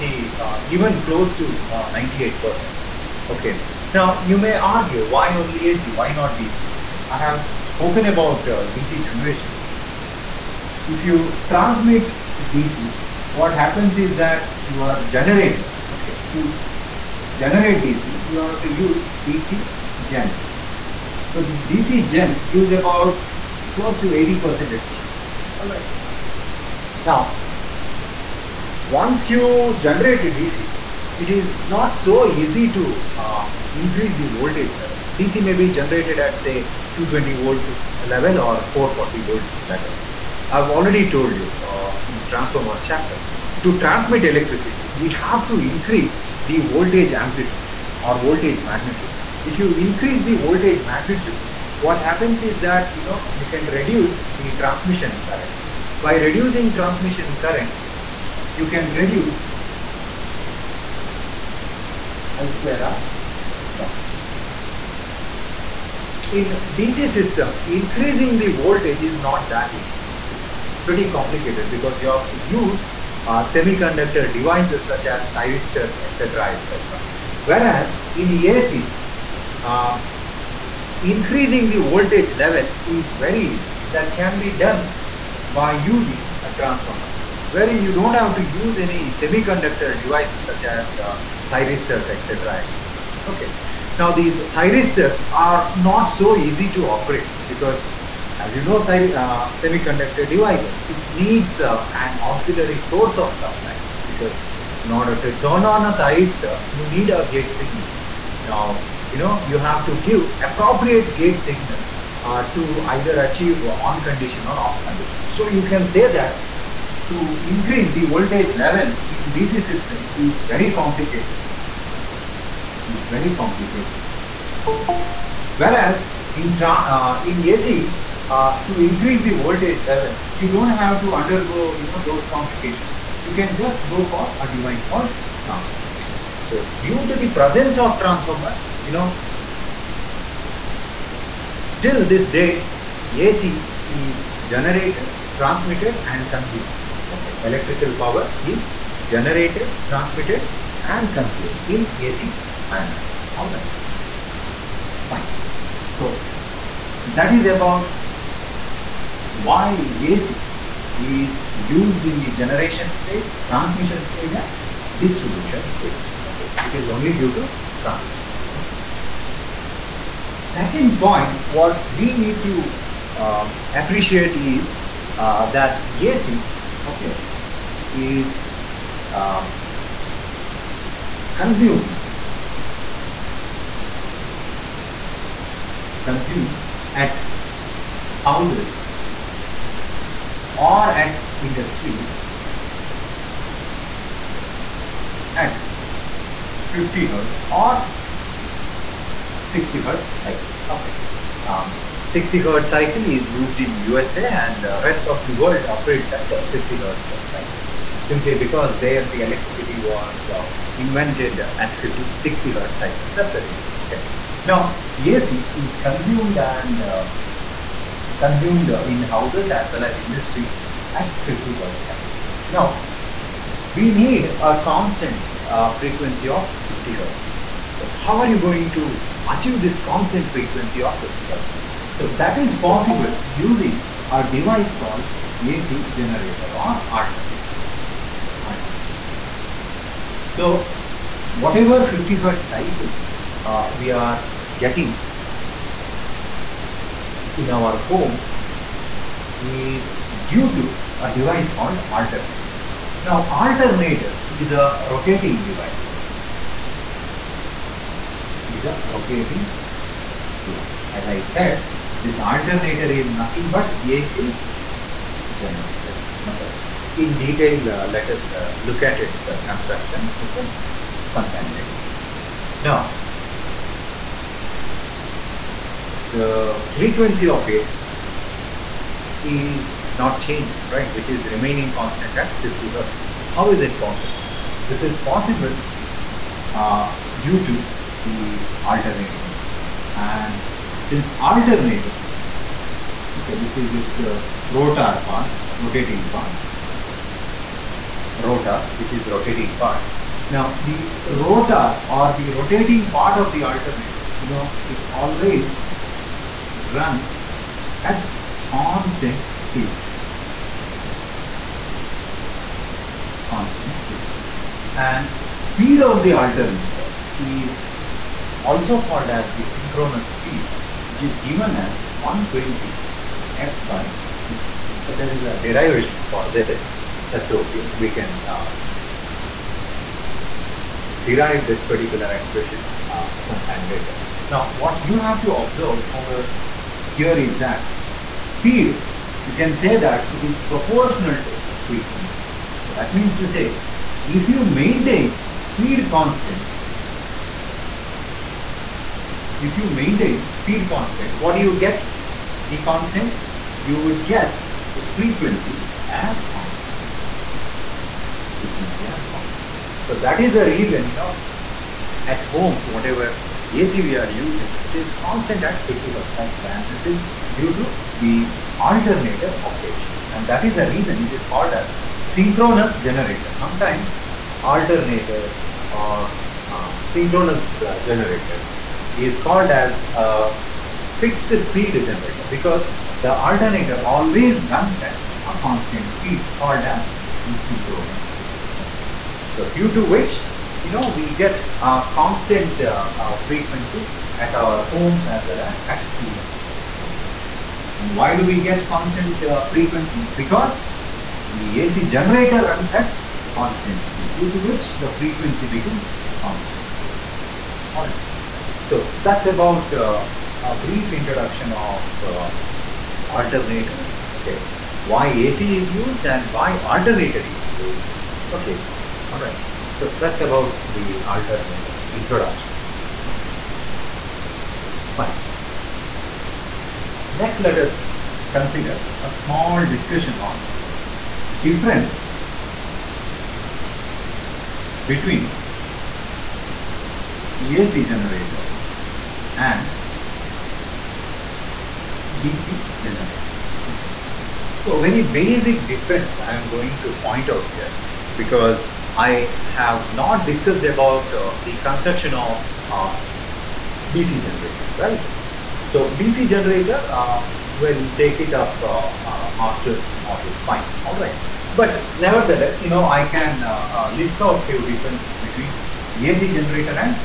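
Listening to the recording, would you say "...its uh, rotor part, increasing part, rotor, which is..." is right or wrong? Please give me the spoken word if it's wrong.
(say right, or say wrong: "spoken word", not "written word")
wrong: "rotating", not "increasing".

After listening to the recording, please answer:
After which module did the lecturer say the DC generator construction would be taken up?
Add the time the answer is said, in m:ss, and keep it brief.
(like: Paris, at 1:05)
module 5, at 7:40.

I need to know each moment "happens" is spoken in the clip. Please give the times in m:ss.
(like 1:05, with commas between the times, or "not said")
0:13, 0:51.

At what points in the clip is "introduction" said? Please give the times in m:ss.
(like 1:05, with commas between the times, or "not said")
6:50, 7:01.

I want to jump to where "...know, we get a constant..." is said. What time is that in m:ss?
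6:30.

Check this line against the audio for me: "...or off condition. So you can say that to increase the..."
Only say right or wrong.
right.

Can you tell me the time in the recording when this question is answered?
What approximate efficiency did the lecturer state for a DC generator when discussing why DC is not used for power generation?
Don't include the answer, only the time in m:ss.
0:23.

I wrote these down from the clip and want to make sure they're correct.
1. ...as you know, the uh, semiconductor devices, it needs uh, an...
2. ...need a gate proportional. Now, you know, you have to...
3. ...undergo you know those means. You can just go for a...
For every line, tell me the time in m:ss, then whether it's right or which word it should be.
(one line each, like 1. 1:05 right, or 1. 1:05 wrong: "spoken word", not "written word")
1. 1:38 right
2. 1:46 wrong: "signal", not "proportional"
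3. 2:11 wrong: "complications", not "means".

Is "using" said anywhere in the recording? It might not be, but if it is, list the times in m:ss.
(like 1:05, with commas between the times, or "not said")
1:25, 3:53, 6:04.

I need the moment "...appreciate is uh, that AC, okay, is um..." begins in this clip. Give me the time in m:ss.
2:53.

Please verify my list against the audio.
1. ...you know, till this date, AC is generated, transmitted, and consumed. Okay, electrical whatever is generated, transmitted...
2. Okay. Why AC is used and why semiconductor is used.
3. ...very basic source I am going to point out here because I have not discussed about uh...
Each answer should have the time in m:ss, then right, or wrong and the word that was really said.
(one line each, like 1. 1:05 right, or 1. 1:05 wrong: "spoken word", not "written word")
1. 2:18 wrong: "power", not "whatever"
2. 6:54 wrong: "alternator", not "semiconductor"
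3. 7:24 wrong: "difference", not "source".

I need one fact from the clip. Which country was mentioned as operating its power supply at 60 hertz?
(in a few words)
USA.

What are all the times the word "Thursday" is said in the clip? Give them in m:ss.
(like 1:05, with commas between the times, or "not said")
not said.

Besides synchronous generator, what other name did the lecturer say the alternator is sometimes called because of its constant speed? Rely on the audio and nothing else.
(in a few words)
fixed speed generator.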